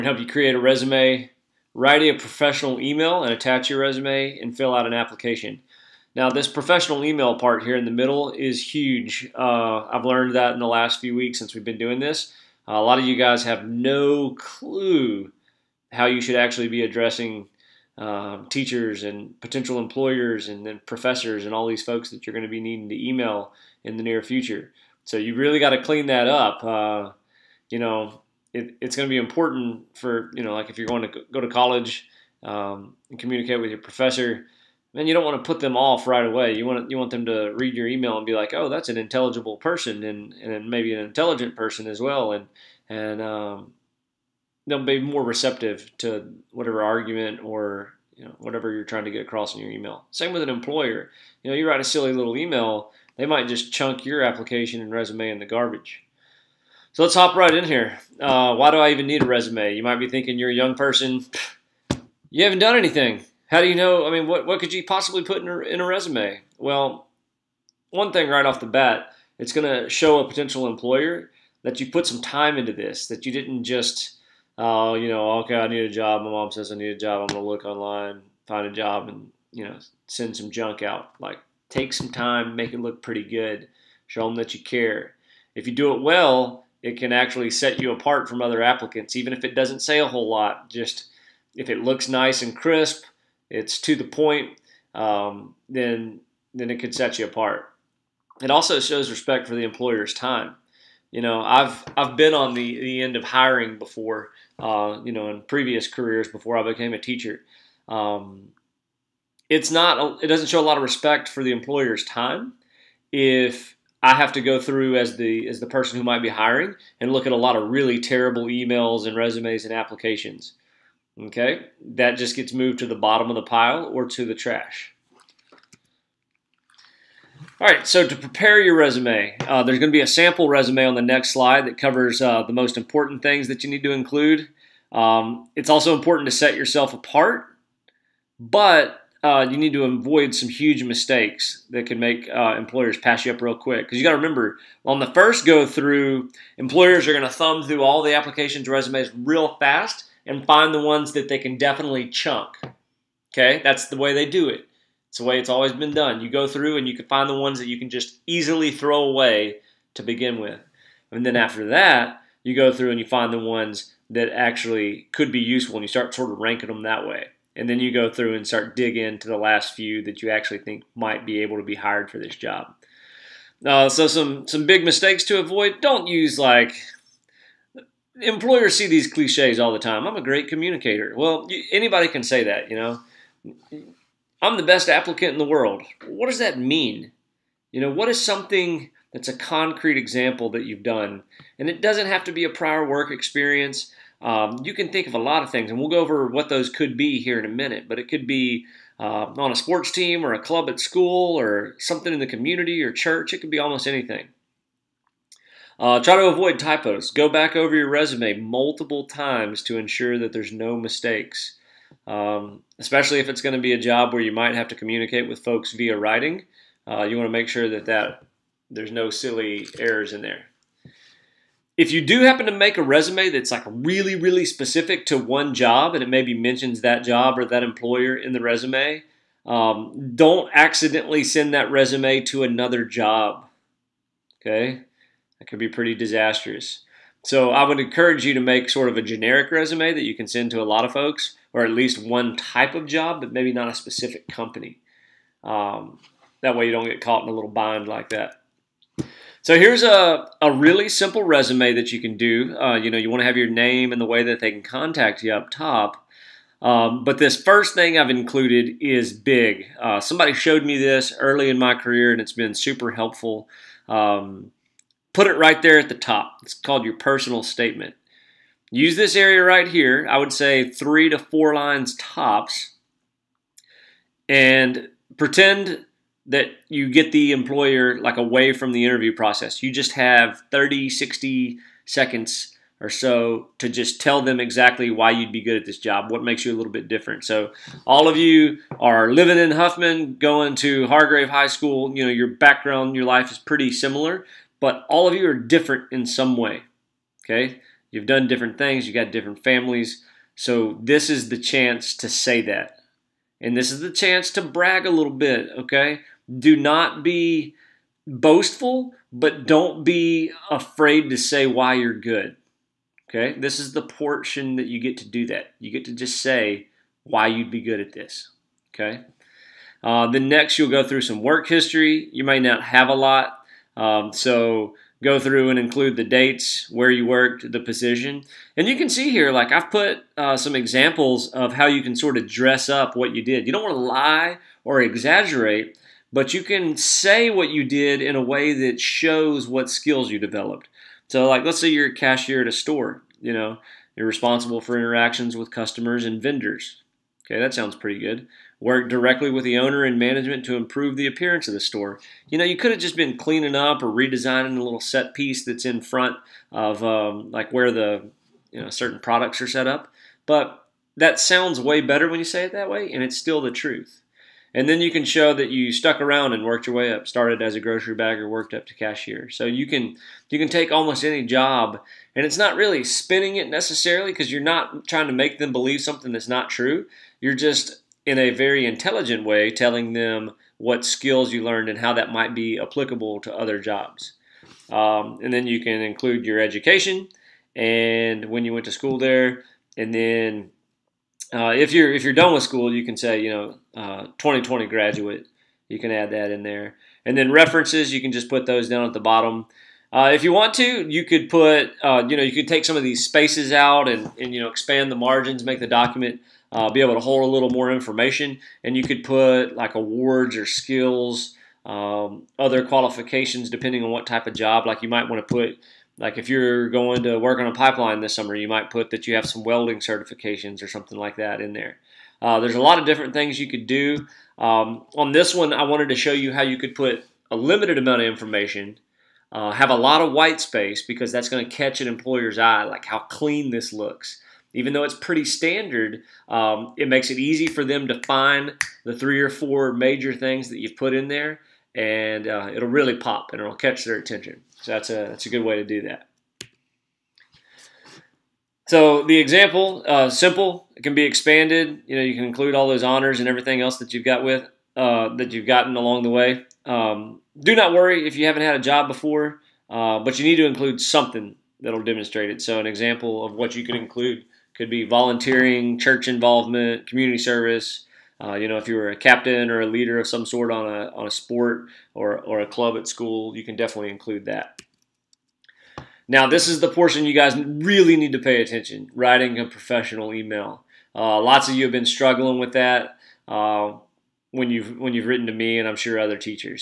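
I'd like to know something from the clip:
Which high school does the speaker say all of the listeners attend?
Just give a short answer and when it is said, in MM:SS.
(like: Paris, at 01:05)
Hargrave High School, at 04:50.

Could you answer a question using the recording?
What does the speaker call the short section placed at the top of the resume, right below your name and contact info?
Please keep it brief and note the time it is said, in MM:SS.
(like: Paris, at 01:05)
Personal statement, at 04:26.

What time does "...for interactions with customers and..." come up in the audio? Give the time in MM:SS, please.
05:44.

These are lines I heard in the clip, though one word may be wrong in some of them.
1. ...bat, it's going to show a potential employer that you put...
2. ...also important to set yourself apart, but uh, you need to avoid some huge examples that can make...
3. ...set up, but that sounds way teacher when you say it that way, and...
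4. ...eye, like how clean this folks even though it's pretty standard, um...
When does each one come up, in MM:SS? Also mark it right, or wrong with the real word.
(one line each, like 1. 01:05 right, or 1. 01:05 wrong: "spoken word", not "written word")
1. 01:08 right
2. 02:15 wrong: "mistakes", not "examples"
3. 05:59 wrong: "better", not "teacher"
4. 07:12 wrong: "looks", not "folks".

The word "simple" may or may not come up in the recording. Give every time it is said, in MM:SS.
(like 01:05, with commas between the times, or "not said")
04:10, 07:30.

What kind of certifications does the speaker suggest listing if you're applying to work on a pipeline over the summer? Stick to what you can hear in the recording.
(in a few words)
Welding certifications.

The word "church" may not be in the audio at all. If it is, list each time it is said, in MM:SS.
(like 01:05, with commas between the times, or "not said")
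03:22, 07:45.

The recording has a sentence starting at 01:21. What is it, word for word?
Like, take some time, make it look pretty good, show them that you care.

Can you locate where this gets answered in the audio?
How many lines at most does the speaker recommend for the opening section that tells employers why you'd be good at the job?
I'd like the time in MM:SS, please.
04:30.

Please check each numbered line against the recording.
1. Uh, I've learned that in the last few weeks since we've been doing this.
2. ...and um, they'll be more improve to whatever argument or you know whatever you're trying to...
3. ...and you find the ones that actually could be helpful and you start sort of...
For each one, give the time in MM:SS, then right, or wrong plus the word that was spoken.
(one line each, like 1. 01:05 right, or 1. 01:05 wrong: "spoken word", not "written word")
1. 00:09 right
2. 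00:42 wrong: "receptive", not "improve"
3. 02:42 wrong: "useful", not "helpful".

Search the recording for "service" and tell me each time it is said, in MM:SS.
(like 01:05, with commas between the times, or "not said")
07:47.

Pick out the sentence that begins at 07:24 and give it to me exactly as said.
So that's a, that's a good way to do that.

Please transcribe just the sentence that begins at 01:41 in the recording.
You know, I've I've been on the, the end of hiring before.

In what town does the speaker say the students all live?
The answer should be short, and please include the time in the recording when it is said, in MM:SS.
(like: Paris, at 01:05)
Huffman, at 04:49.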